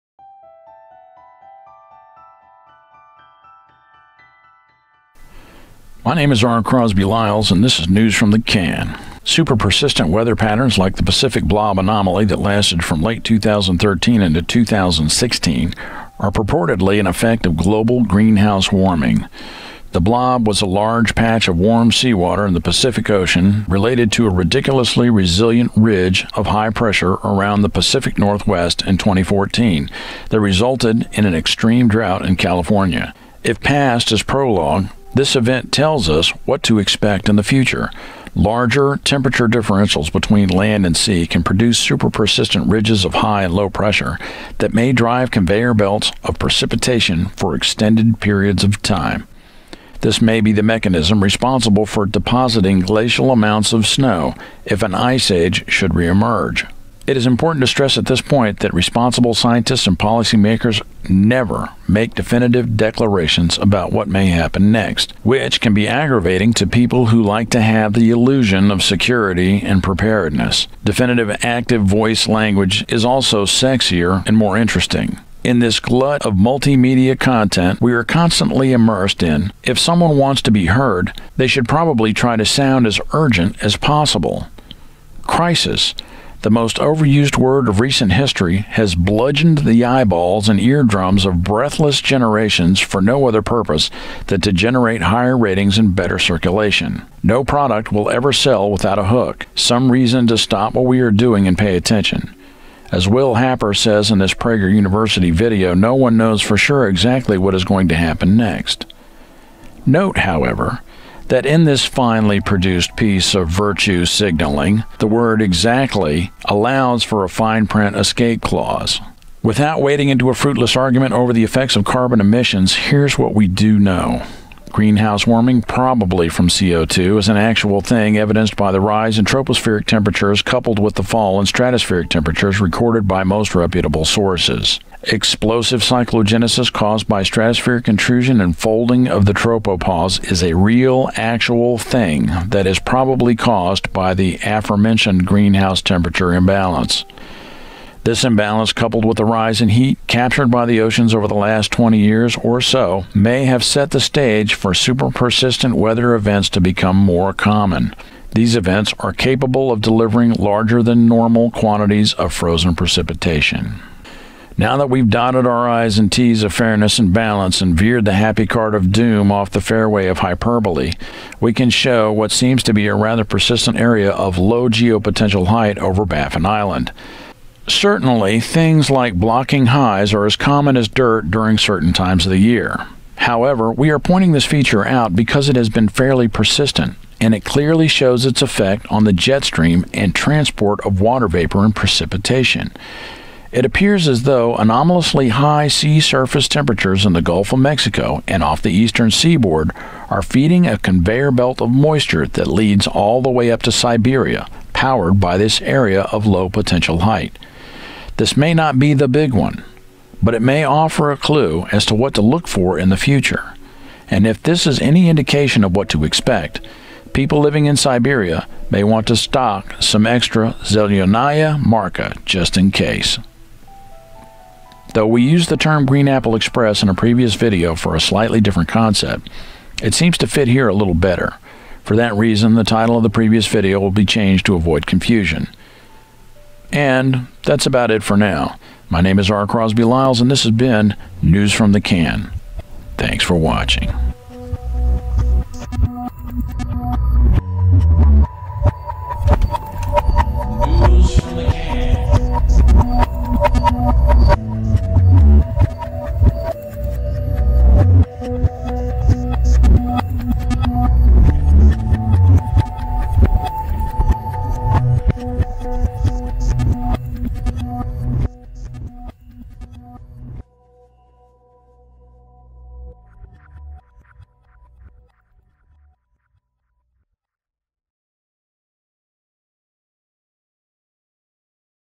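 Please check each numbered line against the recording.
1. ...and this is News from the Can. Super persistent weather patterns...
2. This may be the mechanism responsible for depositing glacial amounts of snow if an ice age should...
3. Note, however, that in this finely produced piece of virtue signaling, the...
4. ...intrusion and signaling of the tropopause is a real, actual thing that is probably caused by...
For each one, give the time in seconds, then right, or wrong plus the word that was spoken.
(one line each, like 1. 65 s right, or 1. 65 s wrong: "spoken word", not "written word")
1. 7 s right
2. 49 s right
3. 109 s right
4. 137 s wrong: "folding", not "signaling".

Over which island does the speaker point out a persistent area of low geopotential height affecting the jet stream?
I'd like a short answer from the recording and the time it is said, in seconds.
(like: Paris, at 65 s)
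Baffin Island, at 176 s.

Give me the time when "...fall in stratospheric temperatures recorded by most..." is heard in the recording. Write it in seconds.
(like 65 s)
131 s.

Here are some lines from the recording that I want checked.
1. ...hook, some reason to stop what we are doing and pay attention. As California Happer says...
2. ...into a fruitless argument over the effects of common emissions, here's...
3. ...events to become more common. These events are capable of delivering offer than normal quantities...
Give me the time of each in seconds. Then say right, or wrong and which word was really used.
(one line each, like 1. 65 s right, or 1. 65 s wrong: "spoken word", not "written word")
1. 99 s wrong: "Will", not "California"
2. 120 s wrong: "carbon", not "common"
3. 156 s wrong: "larger", not "offer".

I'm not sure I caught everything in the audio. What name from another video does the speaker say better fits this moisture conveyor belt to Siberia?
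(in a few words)
Green Apple Express.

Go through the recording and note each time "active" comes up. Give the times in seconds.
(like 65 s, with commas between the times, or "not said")
71 s.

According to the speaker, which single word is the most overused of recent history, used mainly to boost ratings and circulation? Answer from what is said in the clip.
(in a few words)
Crisis.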